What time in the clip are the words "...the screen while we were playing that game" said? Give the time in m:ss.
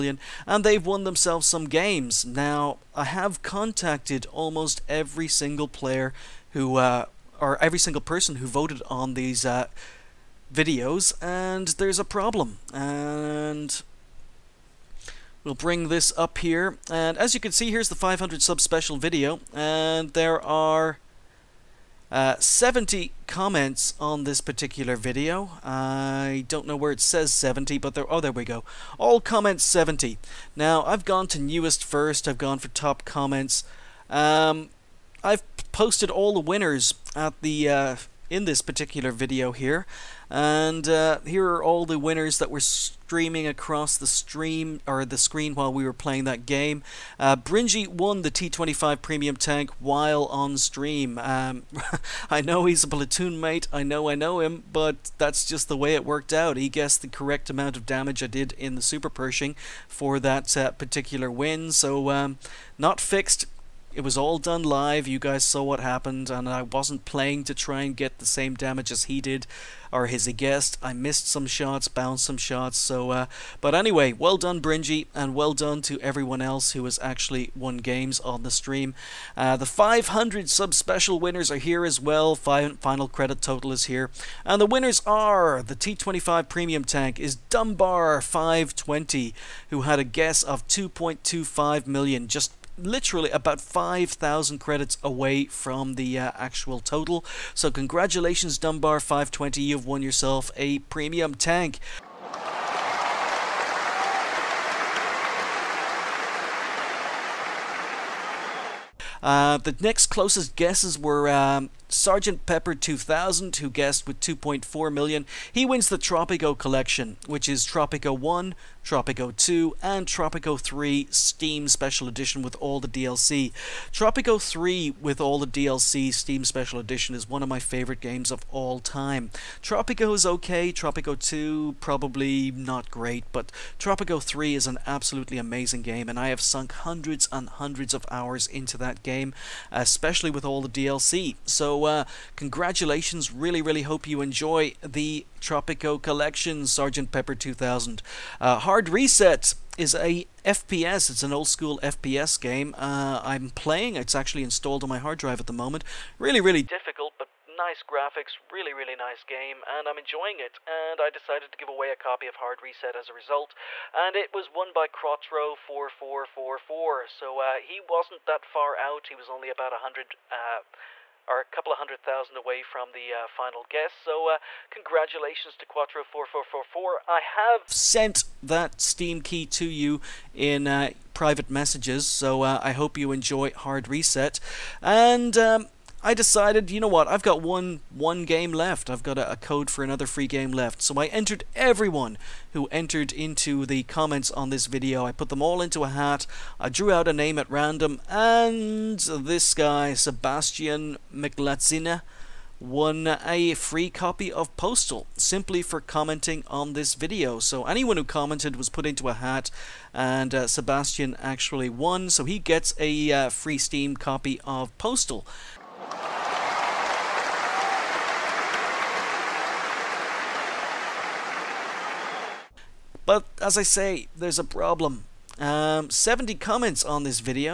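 0:45.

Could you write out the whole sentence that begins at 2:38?
Really, really nice game, and I'm enjoying it.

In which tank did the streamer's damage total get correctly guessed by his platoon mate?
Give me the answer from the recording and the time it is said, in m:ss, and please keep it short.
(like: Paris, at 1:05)
Super Pershing, at 0:58.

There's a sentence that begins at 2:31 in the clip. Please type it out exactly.
It's an old school FPS game.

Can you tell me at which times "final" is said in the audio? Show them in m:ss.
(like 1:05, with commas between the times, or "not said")
1:22, 2:53.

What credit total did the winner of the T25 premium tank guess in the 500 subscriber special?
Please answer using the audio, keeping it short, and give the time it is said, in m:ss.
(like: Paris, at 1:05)
2.25 million, at 1:30.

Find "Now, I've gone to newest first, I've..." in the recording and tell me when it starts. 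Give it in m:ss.
0:30.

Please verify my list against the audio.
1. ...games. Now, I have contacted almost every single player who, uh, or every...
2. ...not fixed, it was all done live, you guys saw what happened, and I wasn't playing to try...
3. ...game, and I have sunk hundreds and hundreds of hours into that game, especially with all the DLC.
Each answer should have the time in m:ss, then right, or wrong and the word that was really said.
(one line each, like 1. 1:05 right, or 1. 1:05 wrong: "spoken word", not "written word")
1. 0:01 right
2. 1:02 right
3. 2:15 right.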